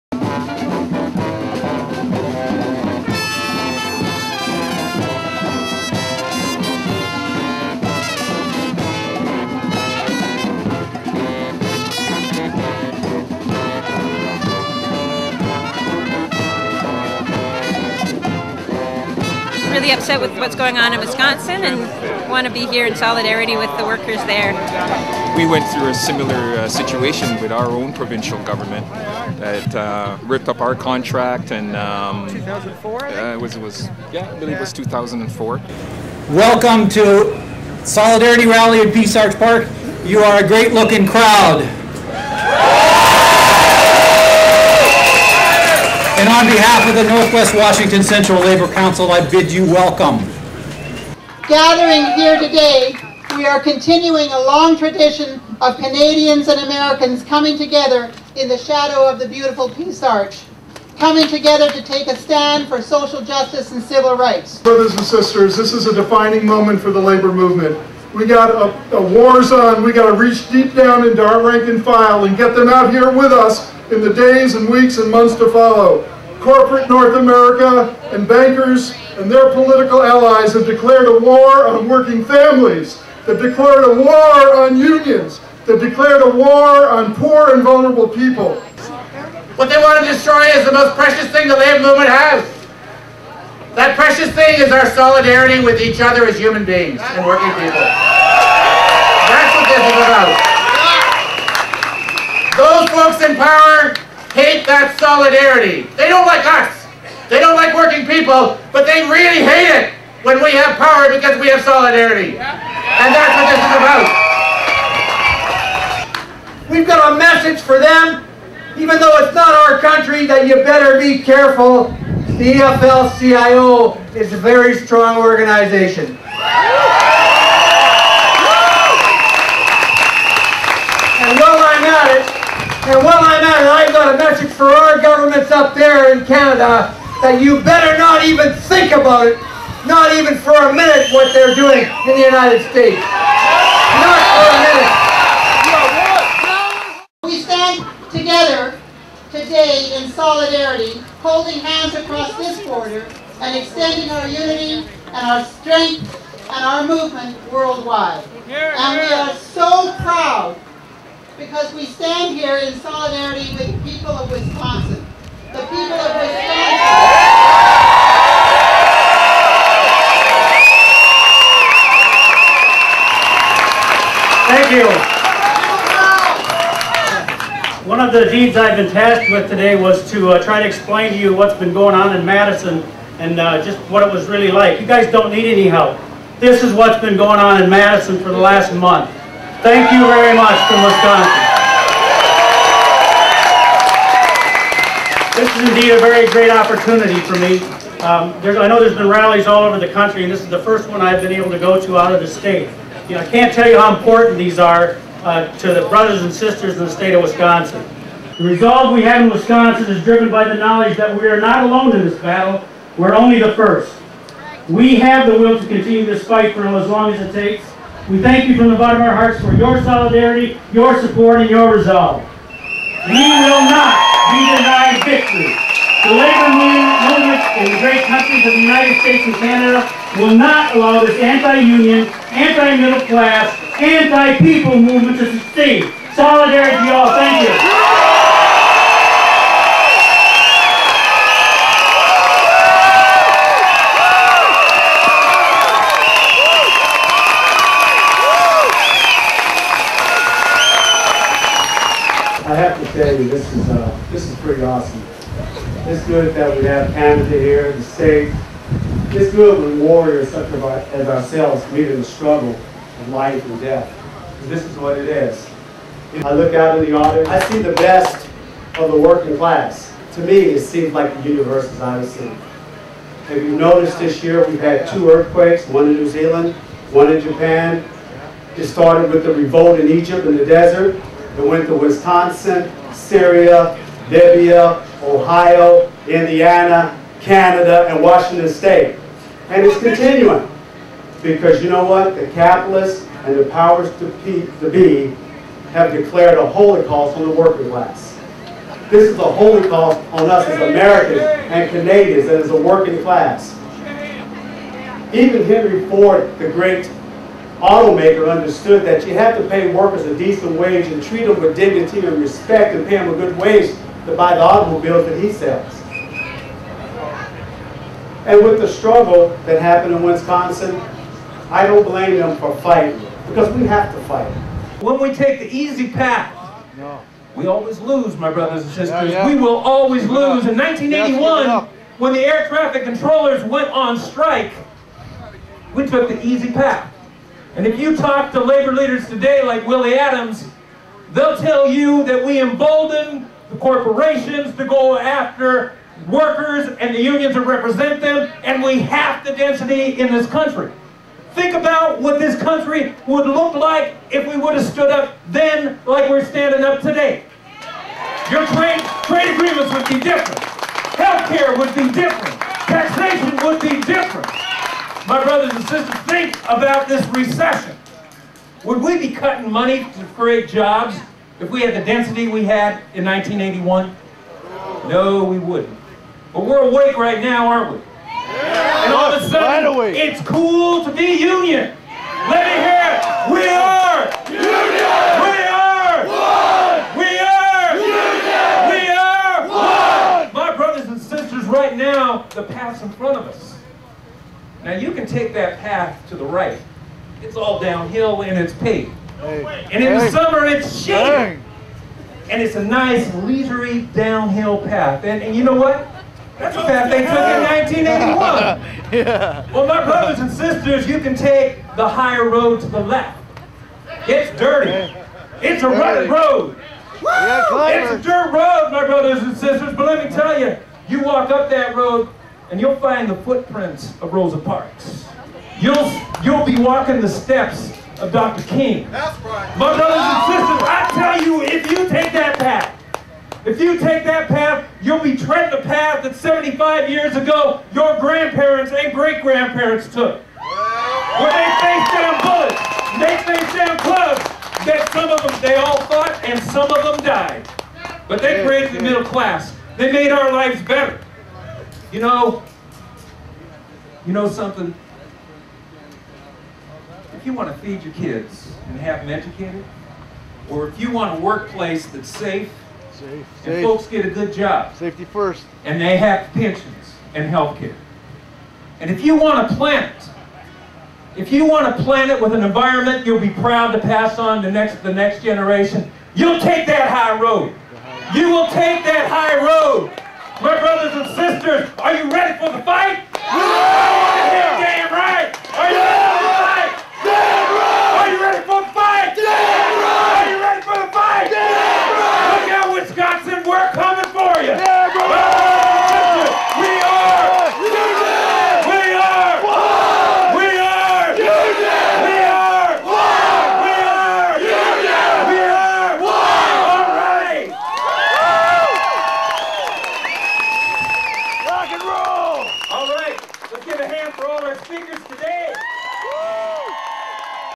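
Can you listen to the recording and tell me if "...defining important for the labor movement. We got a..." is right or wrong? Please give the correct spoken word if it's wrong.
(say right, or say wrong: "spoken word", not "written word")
wrong: "moment", not "important".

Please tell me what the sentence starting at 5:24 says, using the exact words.
When we take the easy path, we always lose, my brothers and sisters.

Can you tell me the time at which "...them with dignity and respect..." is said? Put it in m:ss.
5:11.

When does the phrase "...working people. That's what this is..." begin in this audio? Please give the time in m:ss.
1:37.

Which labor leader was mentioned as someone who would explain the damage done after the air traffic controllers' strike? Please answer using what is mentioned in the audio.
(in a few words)
Willie Adams.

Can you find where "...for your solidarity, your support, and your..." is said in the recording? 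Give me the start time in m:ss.
3:39.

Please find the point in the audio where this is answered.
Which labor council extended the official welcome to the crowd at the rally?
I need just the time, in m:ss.
0:47.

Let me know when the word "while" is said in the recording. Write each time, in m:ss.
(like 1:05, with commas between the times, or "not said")
2:06, 2:13.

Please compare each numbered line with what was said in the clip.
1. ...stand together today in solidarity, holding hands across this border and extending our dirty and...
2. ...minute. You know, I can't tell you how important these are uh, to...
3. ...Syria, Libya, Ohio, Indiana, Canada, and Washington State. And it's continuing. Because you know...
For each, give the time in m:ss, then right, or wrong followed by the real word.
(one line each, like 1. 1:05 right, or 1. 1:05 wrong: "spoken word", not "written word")
1. 2:27 wrong: "unity", not "dirty"
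2. 3:22 wrong: "state", not "minute"
3. 4:42 right.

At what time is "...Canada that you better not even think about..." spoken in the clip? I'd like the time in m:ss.
2:16.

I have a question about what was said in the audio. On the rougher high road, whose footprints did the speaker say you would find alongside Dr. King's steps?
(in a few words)
Rosa Parks.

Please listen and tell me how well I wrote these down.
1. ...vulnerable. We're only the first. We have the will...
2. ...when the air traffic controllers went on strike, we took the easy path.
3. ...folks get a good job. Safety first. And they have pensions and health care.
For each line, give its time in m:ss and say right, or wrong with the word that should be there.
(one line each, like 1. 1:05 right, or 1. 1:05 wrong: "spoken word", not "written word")
1. 3:32 wrong: "battle", not "vulnerable"
2. 5:31 right
3. 7:43 right.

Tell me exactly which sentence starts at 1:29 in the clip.
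What they want to destroy is the most precious thing the labor movement has.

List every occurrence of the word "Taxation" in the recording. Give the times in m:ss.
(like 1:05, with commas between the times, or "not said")
6:02.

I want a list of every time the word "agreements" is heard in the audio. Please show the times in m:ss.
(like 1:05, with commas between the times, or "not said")
5:59.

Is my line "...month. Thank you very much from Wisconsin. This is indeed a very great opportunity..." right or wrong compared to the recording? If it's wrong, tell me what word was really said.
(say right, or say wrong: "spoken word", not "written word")
right.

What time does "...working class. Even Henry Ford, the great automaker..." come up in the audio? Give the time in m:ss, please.
5:02.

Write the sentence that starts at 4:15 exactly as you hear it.
It's good that we have Canada here, the state.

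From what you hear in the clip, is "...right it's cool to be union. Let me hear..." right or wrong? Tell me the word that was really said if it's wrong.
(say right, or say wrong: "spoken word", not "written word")
right.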